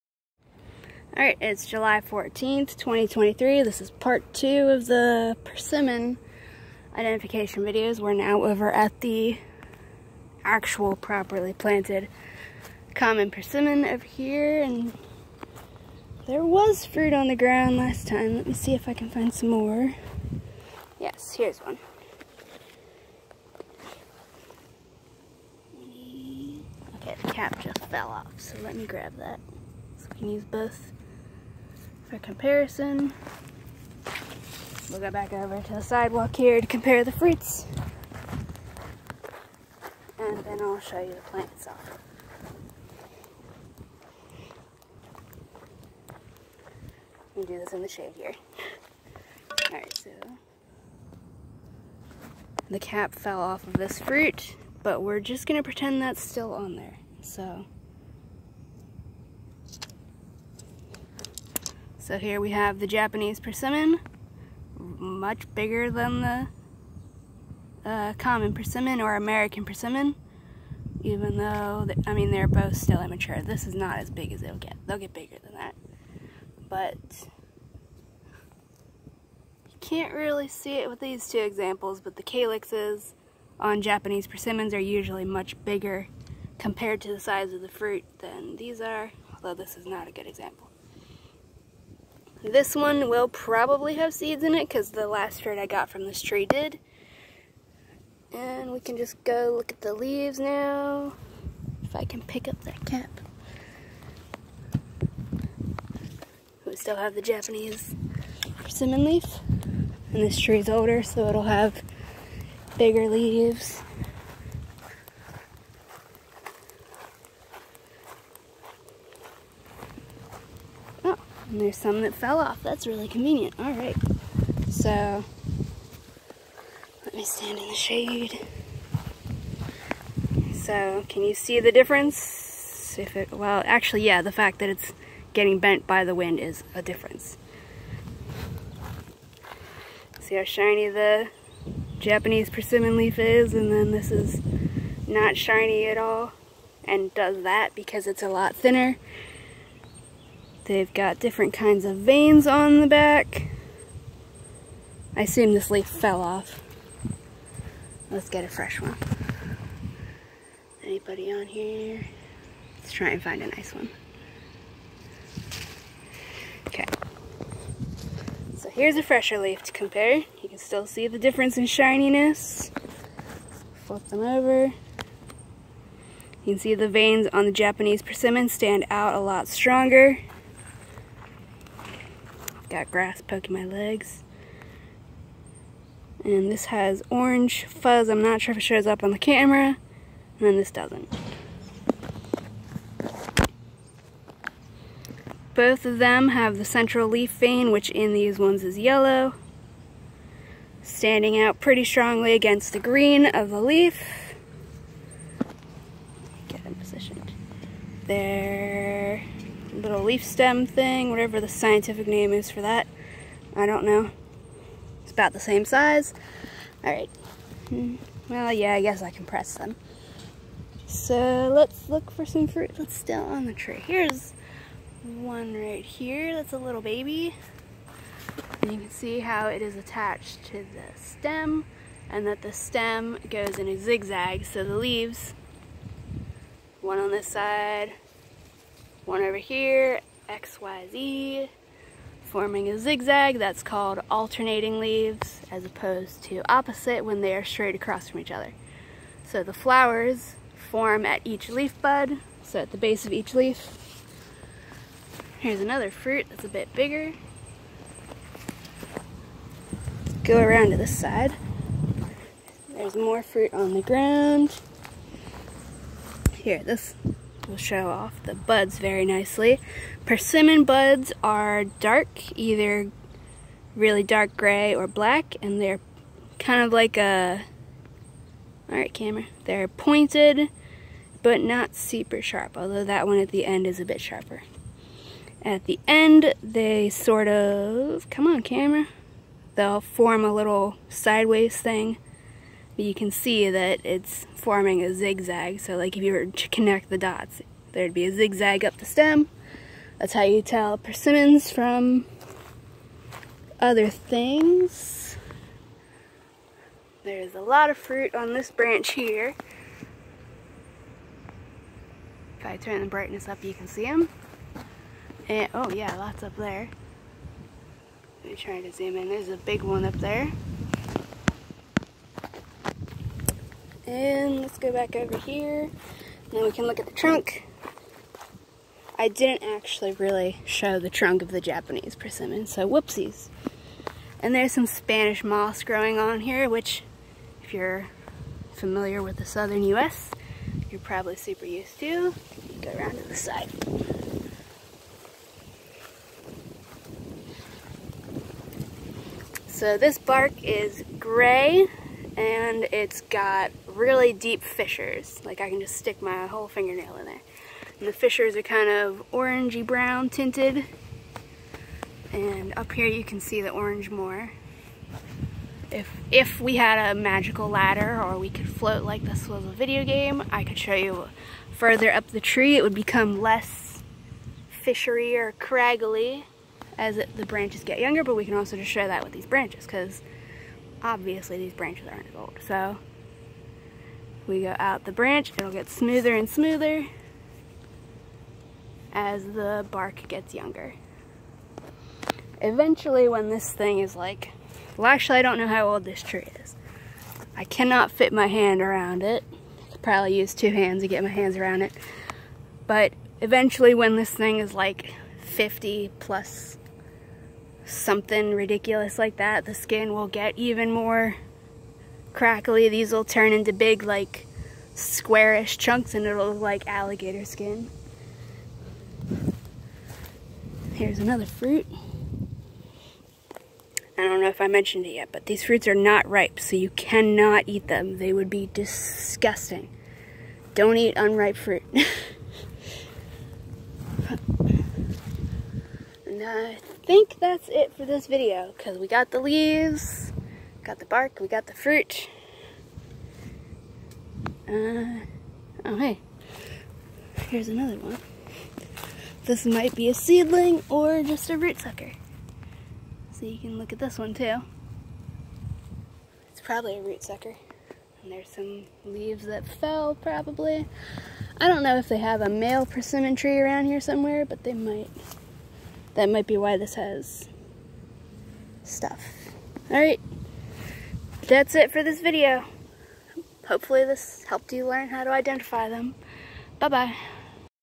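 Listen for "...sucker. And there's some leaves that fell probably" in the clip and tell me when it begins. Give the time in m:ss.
7:37.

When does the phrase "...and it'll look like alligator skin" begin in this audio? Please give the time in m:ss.
6:55.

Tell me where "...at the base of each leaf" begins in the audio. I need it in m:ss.
4:12.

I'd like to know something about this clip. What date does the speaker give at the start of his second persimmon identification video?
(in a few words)
July 14th, 2023.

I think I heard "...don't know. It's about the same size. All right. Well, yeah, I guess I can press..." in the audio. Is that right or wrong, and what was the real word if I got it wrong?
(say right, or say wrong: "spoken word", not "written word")
right.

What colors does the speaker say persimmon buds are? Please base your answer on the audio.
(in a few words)
Dark gray or black.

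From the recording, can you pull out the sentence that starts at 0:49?
Alright, so the cap fell off of this fruit, but we're just gonna pretend that's still on there.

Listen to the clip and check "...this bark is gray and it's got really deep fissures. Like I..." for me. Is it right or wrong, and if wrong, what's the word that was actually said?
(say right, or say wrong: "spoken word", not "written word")
right.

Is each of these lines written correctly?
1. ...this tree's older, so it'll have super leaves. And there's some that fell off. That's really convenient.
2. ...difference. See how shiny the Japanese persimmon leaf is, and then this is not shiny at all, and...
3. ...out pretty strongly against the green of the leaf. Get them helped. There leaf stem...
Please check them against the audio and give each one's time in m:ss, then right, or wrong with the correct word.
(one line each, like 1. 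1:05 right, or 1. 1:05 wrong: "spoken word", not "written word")
1. 1:50 wrong: "bigger", not "super"
2. 2:16 right
3. 3:21 wrong: "positioned", not "helped".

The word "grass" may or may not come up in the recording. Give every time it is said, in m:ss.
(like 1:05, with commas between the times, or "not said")
3:02.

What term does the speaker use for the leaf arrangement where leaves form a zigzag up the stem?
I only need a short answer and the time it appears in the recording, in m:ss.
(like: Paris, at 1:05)
Alternating, at 4:04.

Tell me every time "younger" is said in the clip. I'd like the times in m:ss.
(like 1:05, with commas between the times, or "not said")
6:17, 6:30.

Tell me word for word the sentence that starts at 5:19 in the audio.
There's a big one up there.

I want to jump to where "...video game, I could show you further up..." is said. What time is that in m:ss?
6:09.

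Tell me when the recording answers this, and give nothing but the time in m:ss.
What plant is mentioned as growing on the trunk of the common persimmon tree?
5:34.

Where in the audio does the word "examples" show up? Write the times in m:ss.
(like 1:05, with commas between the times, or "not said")
1:21, 1:30.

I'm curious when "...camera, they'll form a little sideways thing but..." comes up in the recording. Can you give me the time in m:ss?
4:48.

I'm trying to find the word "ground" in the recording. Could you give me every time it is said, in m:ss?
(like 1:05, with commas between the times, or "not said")
0:17, 4:23.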